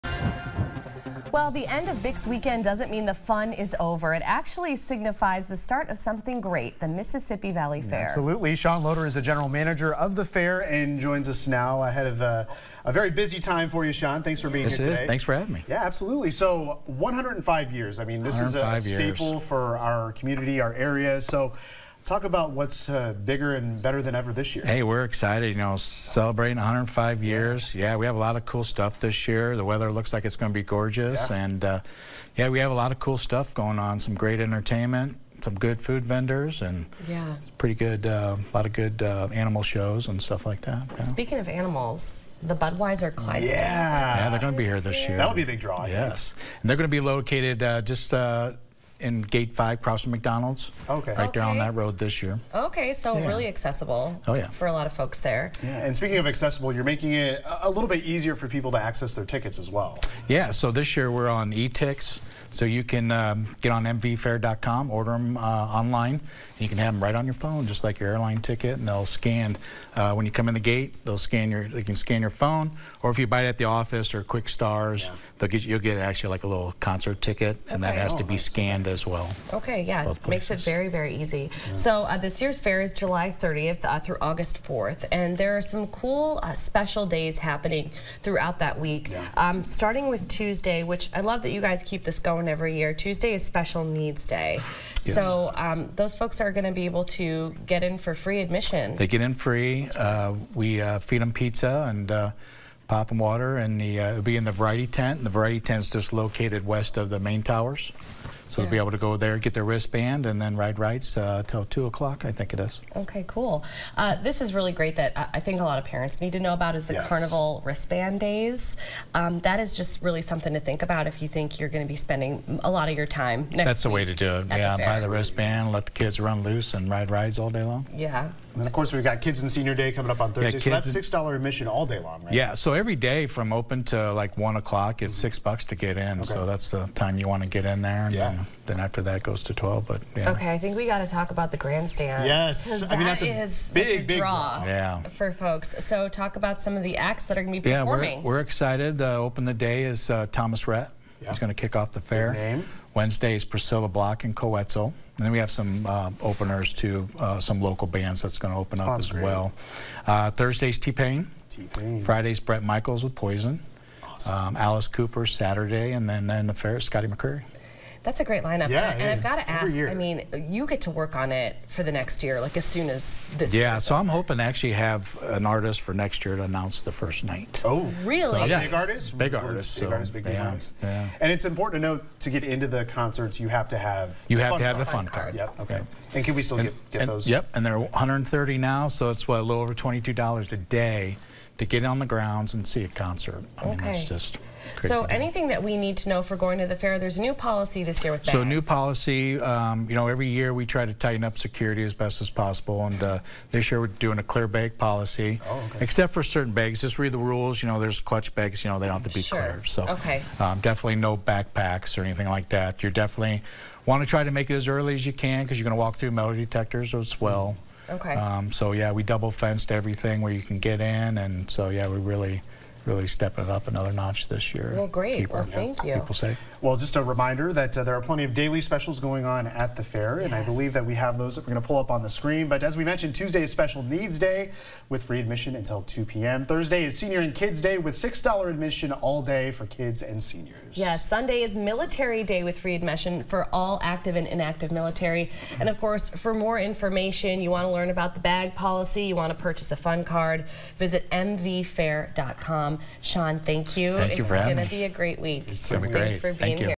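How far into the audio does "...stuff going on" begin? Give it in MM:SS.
00:33.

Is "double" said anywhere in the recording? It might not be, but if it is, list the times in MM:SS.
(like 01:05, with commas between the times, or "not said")
03:39.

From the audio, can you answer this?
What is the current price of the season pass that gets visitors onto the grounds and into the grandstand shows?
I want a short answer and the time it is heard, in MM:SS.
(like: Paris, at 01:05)
$130, at 03:07.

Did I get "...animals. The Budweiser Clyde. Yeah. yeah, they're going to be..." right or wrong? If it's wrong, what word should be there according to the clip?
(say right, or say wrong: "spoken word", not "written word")
right.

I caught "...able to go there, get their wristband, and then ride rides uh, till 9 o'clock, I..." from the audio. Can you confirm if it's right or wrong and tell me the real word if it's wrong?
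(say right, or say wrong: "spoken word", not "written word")
wrong: "2", not "9".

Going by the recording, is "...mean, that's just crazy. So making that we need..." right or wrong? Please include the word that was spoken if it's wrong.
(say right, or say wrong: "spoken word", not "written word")
wrong: "anything", not "making".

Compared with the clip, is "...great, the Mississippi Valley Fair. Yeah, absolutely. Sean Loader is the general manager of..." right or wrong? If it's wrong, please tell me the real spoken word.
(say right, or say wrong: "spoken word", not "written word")
right.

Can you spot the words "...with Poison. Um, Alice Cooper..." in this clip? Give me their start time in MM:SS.
02:43.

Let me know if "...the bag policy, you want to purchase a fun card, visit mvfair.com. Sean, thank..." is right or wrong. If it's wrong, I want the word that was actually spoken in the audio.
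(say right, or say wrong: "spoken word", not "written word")
right.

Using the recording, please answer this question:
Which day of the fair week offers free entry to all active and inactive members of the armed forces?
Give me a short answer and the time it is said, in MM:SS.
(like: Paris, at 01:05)
Sunday, at 04:01.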